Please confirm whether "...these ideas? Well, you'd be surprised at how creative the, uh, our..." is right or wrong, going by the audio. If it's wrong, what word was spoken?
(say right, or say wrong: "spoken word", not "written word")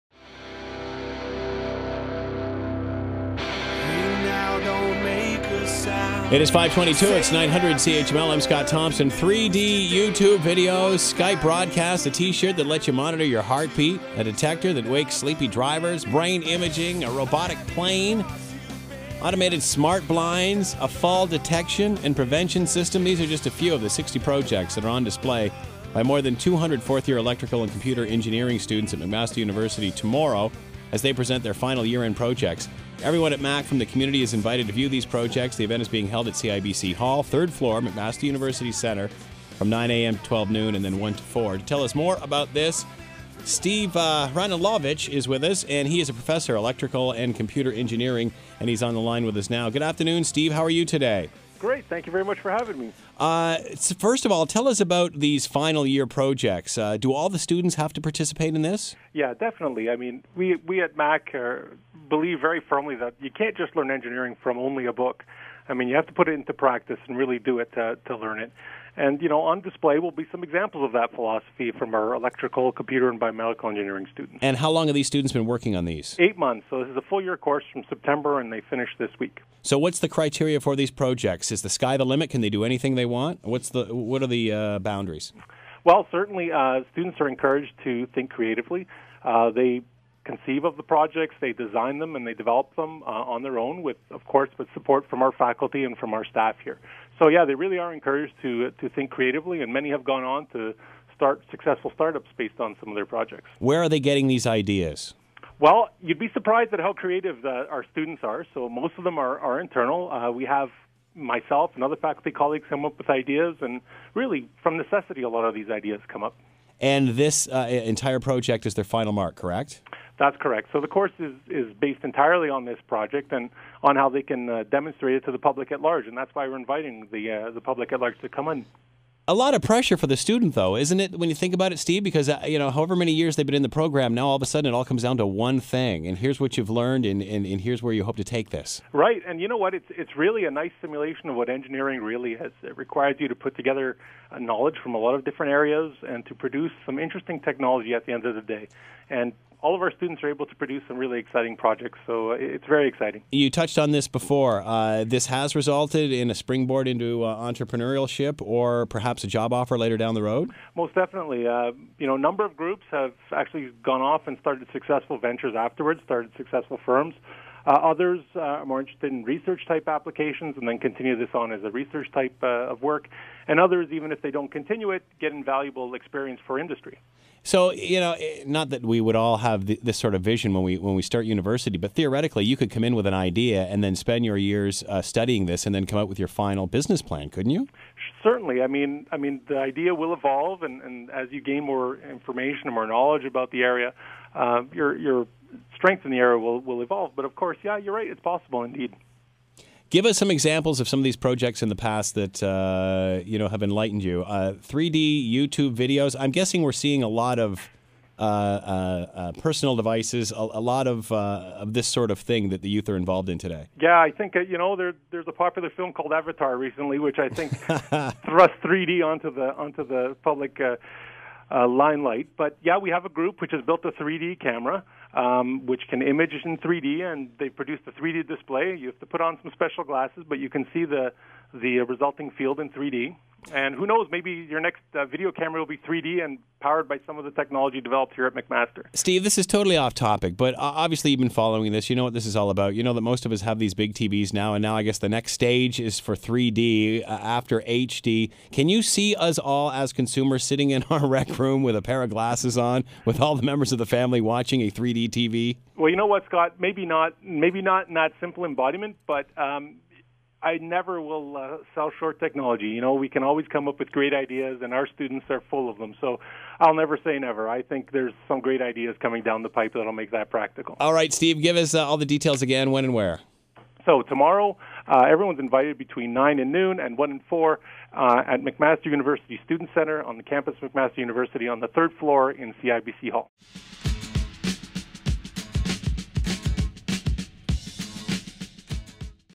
right.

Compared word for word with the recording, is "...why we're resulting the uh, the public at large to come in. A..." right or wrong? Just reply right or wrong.
wrong.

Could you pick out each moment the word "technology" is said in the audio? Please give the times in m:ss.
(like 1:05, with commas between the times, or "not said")
2:27, 3:57, 4:22.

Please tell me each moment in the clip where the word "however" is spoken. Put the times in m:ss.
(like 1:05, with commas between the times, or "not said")
2:12.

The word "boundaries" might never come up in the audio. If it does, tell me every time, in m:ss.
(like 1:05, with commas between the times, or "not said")
1:24.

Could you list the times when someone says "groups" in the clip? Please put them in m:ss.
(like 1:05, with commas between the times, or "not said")
2:42, 3:43.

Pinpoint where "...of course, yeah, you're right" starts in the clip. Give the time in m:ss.
3:17.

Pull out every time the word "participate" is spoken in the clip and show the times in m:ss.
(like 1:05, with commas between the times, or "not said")
0:58.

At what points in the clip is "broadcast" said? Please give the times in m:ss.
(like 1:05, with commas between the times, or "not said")
0:11.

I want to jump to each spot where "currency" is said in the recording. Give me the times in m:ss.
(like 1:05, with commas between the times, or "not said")
not said.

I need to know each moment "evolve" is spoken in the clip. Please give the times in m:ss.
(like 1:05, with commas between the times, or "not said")
3:10, 3:16.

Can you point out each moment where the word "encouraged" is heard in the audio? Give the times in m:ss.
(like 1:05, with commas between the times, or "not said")
1:27, 1:37.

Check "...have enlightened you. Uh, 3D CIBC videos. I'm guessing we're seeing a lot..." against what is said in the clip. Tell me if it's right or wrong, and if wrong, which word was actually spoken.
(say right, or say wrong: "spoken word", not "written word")
wrong: "YouTube", not "CIBC".